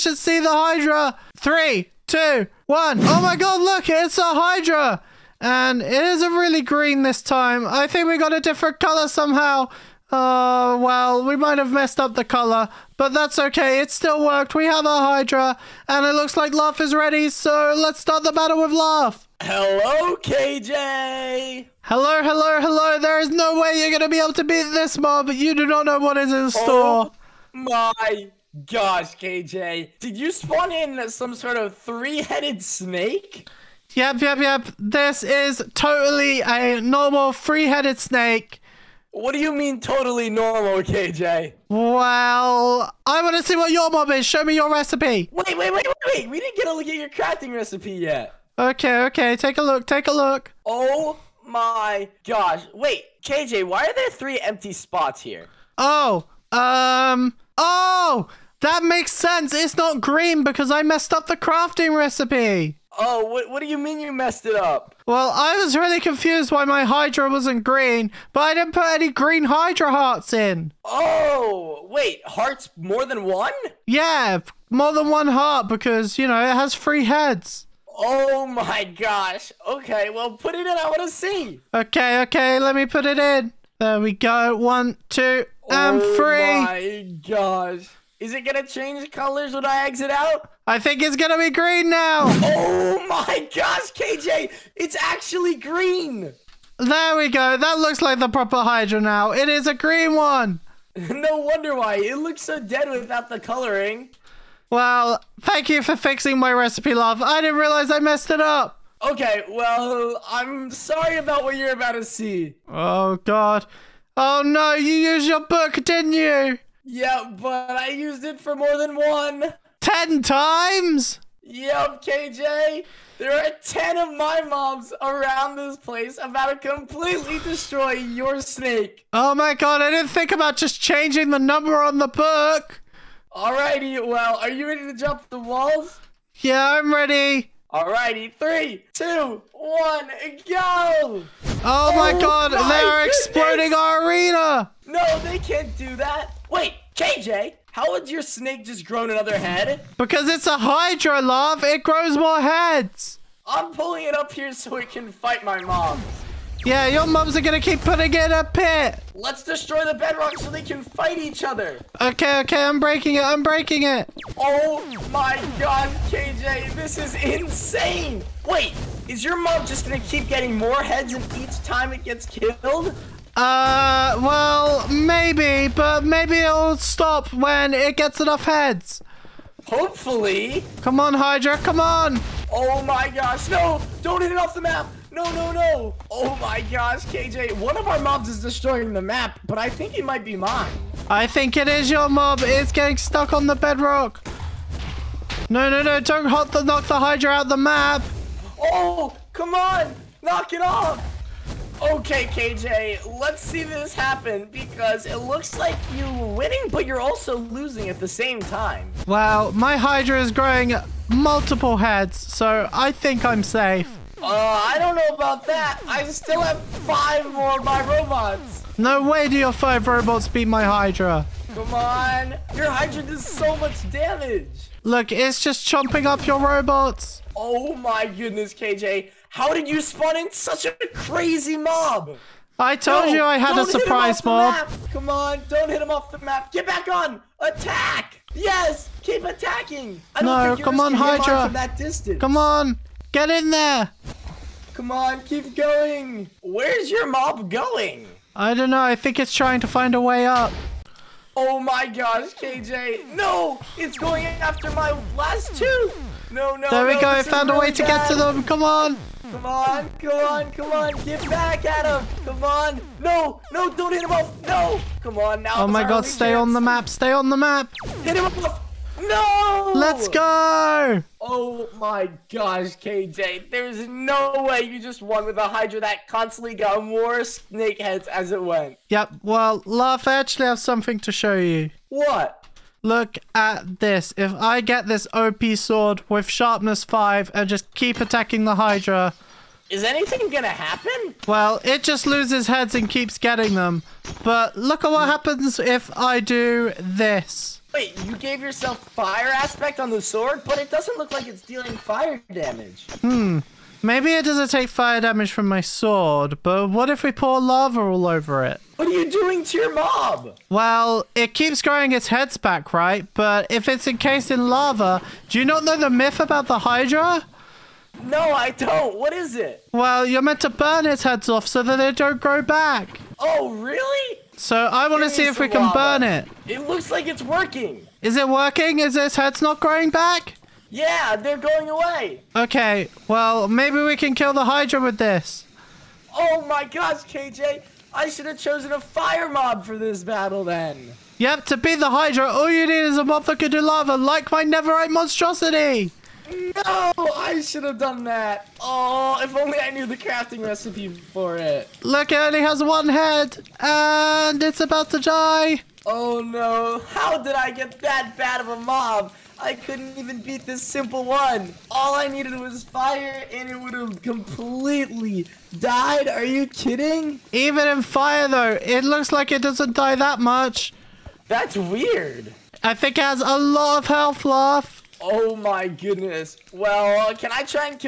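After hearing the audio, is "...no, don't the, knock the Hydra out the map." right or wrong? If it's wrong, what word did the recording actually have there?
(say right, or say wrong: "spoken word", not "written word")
right.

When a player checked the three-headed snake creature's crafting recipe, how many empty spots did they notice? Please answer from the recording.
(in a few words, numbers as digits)
3.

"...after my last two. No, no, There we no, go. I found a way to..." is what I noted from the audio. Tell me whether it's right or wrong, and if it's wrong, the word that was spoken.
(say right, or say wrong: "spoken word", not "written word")
right.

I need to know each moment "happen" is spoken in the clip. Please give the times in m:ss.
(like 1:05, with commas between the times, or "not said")
3:23, 4:50, 4:55.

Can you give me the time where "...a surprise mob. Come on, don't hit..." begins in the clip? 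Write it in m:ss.
3:53.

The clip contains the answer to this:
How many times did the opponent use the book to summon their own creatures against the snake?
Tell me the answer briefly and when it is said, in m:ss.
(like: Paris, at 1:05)
10, at 1:59.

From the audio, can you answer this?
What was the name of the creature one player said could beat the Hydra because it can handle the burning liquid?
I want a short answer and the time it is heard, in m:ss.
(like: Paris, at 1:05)
Netherite monstrosity, at 5:44.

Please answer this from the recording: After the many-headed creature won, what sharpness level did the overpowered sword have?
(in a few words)
5.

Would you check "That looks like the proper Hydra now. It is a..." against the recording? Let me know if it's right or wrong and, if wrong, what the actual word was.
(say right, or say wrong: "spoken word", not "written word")
right.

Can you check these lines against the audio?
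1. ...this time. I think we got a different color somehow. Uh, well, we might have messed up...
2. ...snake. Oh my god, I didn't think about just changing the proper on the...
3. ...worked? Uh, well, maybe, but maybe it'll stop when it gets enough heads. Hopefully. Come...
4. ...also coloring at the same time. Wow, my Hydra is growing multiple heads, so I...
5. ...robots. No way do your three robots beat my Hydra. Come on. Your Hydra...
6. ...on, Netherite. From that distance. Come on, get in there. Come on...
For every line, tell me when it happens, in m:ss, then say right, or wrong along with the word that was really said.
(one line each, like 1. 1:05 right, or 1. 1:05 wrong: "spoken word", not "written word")
1. 0:07 right
2. 2:08 wrong: "number", not "proper"
3. 2:52 wrong: "killed", not "worked"
4. 3:26 wrong: "losing", not "coloring"
5. 3:37 wrong: "five", not "three"
6. 4:00 wrong: "Hydra", not "Netherite".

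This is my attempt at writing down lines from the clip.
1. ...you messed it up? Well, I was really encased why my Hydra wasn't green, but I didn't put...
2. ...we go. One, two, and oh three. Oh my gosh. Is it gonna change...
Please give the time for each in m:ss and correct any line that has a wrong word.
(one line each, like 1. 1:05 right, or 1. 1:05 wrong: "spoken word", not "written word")
1. 1:03 wrong: "confused", not "encased"
2. 1:23 right.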